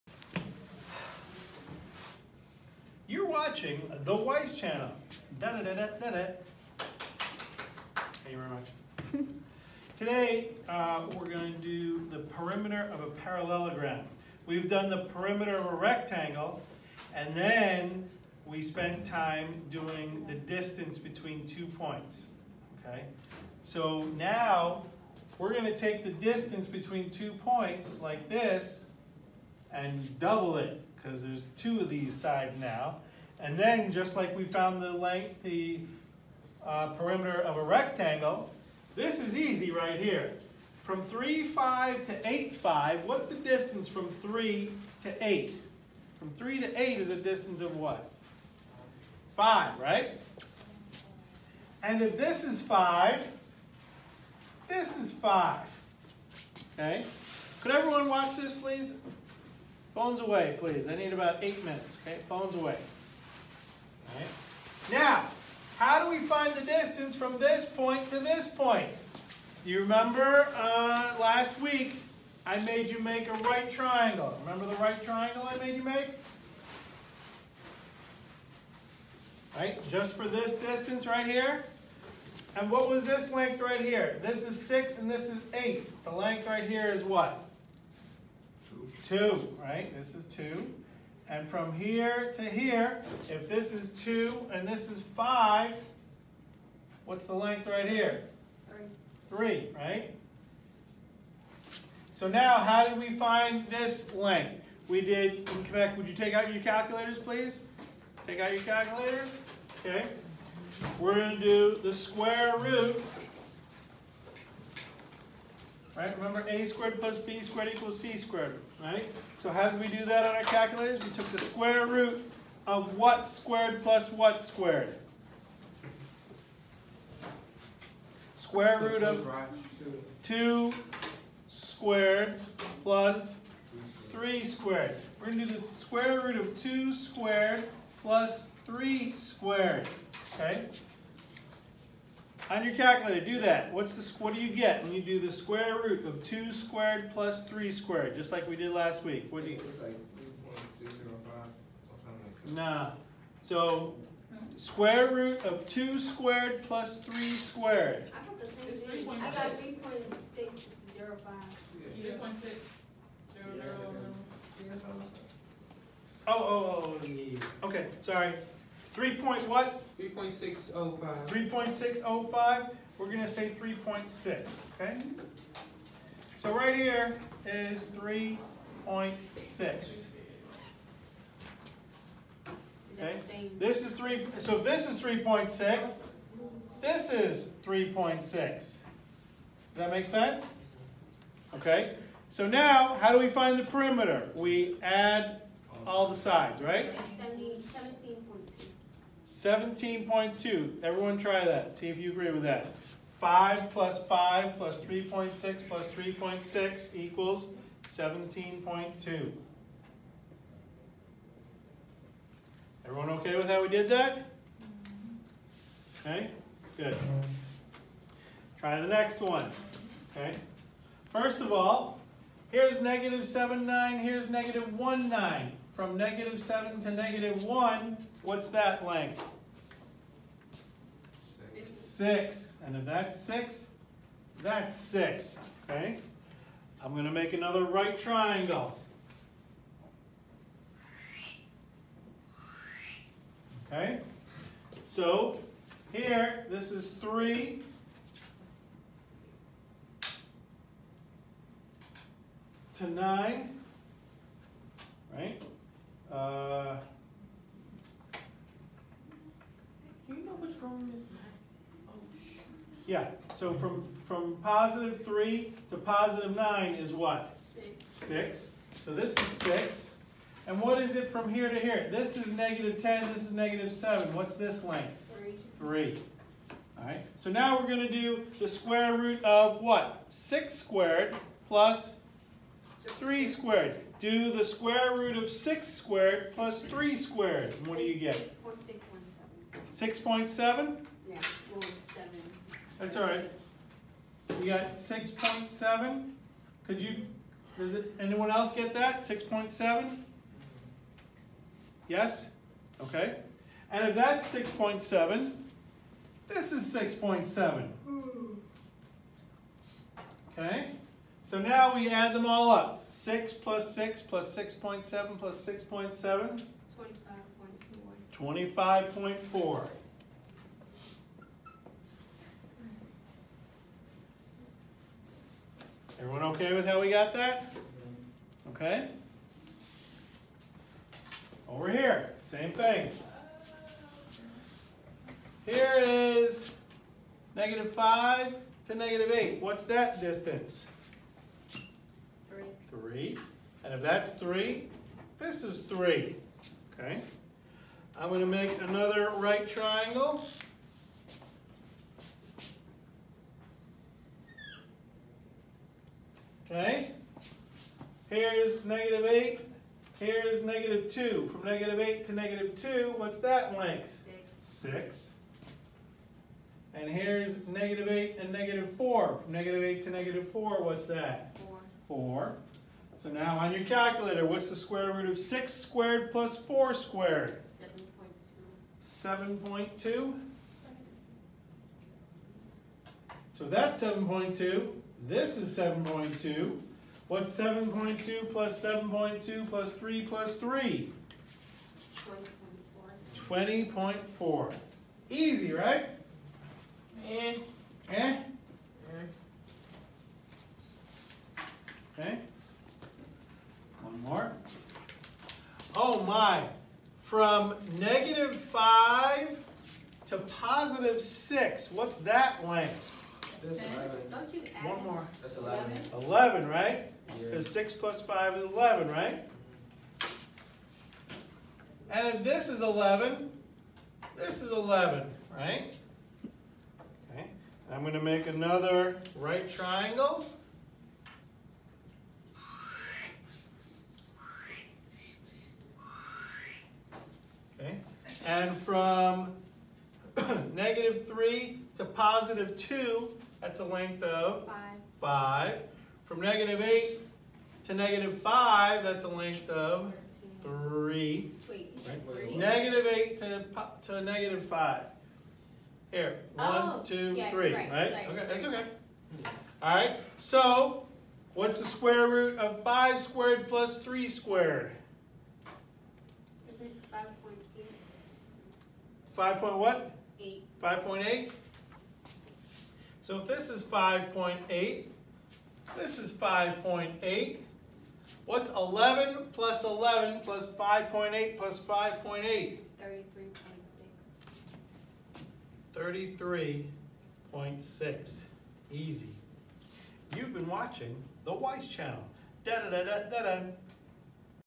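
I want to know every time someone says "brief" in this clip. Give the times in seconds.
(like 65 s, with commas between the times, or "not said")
not said.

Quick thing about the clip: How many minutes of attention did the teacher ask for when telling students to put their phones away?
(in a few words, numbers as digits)
8.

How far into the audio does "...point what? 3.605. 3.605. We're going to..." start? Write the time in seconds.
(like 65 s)
169 s.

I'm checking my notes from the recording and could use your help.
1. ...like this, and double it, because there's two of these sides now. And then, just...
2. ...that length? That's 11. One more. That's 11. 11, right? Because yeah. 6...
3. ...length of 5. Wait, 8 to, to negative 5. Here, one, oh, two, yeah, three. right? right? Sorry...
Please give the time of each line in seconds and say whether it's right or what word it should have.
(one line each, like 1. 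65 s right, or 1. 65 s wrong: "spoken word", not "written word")
1. 28 s right
2. 411 s right
3. 449 s wrong: "3", not "5".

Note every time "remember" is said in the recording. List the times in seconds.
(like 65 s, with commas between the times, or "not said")
69 s, 74 s, 116 s.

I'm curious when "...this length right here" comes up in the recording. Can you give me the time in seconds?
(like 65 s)
83 s.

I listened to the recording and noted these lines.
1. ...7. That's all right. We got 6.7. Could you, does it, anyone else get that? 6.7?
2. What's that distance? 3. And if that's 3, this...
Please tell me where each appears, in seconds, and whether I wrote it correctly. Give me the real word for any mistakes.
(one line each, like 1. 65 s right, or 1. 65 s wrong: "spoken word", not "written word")
1. 291 s right
2. 339 s right.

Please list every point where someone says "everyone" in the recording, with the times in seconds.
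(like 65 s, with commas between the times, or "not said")
57 s, 200 s, 212 s, 326 s.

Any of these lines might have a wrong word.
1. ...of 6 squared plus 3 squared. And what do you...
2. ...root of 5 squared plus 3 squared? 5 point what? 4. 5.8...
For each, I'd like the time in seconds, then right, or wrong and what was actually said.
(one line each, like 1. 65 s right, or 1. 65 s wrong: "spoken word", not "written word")
1. 285 s right
2. 462 s wrong: "8", not "4".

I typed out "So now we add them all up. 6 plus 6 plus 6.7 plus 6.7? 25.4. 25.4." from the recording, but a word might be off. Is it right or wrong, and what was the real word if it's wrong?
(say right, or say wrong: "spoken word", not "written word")
right.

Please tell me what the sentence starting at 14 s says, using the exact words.
We've done the perimeter of a rectangle, and then we spent time doing the distance between two points.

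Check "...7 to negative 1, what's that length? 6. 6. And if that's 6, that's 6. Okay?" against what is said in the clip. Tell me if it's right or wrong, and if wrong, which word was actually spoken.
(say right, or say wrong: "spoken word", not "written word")
right.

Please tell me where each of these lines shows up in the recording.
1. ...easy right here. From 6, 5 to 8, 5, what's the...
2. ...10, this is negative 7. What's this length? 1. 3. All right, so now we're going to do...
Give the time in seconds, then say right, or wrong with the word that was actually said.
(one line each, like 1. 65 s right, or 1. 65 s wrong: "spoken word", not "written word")
1. 39 s wrong: "3", not "6"
2. 272 s wrong: "3", not "1".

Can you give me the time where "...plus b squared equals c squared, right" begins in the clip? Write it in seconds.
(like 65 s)
116 s.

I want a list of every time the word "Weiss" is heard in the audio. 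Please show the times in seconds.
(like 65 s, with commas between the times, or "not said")
4 s, 491 s.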